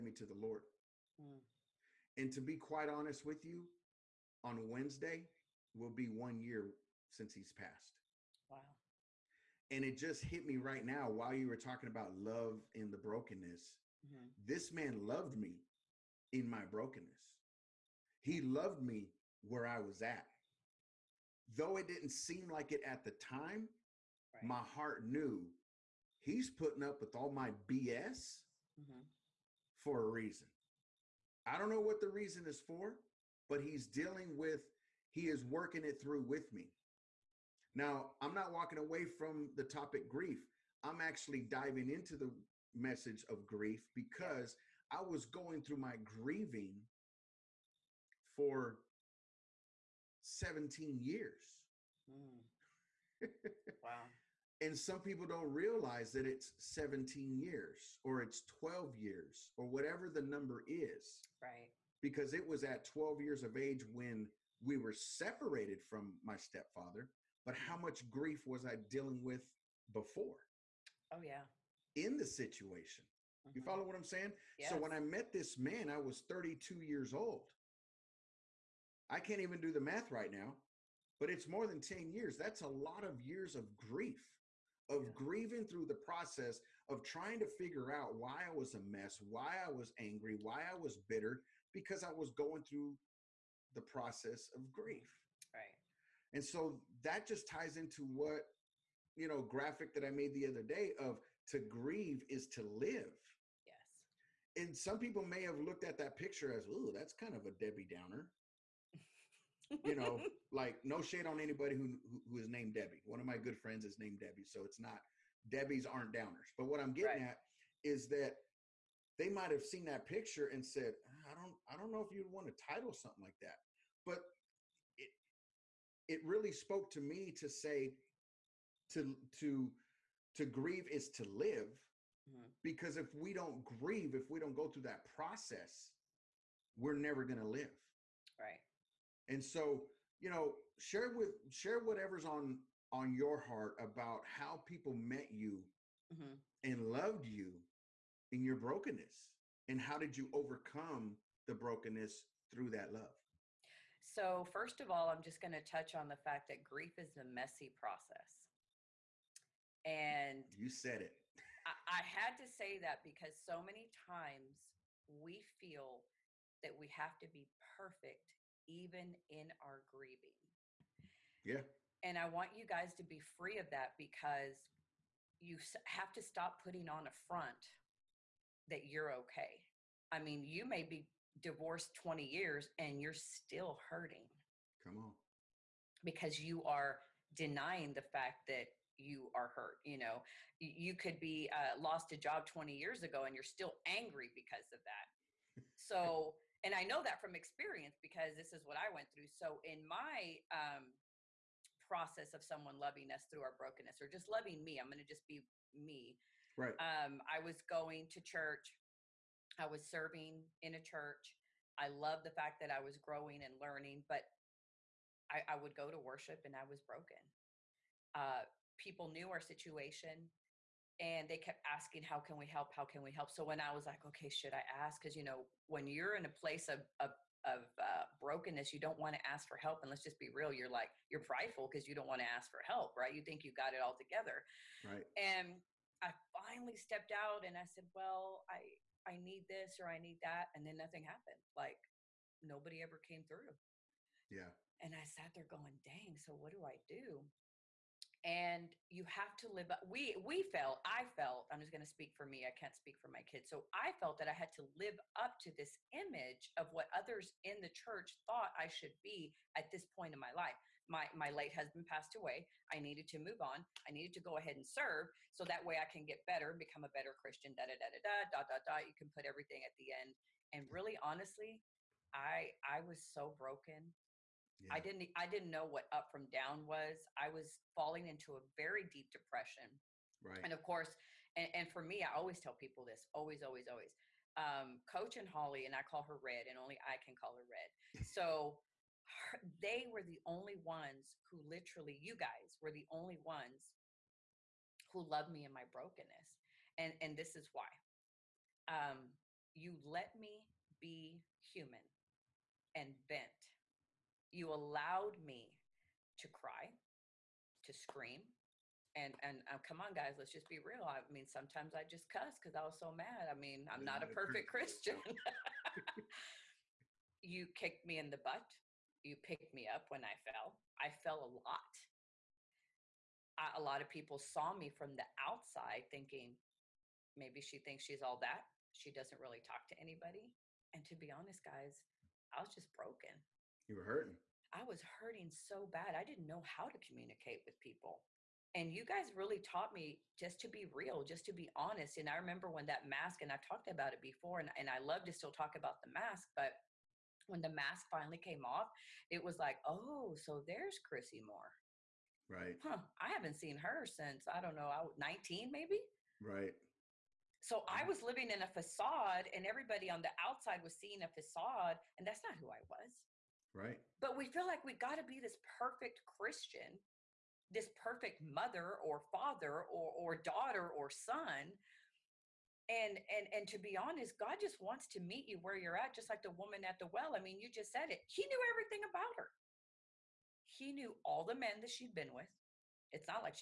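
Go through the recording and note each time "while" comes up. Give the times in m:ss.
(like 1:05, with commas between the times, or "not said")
0:11.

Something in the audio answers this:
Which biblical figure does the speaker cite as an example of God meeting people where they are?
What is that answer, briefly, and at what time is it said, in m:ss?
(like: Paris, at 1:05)
The woman at the well, at 6:16.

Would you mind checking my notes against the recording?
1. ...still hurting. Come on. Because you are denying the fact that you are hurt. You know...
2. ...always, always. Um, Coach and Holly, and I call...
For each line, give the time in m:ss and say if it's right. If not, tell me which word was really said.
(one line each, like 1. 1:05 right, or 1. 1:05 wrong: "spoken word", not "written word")
1. 3:03 right
2. 4:43 right.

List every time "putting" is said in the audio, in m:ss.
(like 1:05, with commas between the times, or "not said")
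0:26, 2:56.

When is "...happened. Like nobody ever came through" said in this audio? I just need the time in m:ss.
4:01.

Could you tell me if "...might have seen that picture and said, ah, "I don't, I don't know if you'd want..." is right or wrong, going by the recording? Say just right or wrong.
right.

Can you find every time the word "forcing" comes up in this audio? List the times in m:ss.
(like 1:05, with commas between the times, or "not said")
not said.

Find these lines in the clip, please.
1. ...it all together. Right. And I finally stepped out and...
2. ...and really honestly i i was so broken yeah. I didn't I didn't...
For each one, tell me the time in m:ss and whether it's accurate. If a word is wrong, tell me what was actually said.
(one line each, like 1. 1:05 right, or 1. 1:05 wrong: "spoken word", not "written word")
1. 3:53 right
2. 4:30 right.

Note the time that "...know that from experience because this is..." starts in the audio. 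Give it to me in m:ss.
3:16.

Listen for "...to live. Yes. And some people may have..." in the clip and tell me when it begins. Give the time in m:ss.
1:42.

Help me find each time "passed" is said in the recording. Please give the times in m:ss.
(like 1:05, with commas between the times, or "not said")
0:07, 4:21.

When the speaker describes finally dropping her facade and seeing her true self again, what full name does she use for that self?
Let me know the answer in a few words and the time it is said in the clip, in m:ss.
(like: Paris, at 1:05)
Chrissie Moore, at 5:50.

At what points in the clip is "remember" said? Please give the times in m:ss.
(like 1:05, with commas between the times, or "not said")
5:42.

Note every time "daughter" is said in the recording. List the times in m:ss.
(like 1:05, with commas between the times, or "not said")
6:10.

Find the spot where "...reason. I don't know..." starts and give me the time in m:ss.
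0:30.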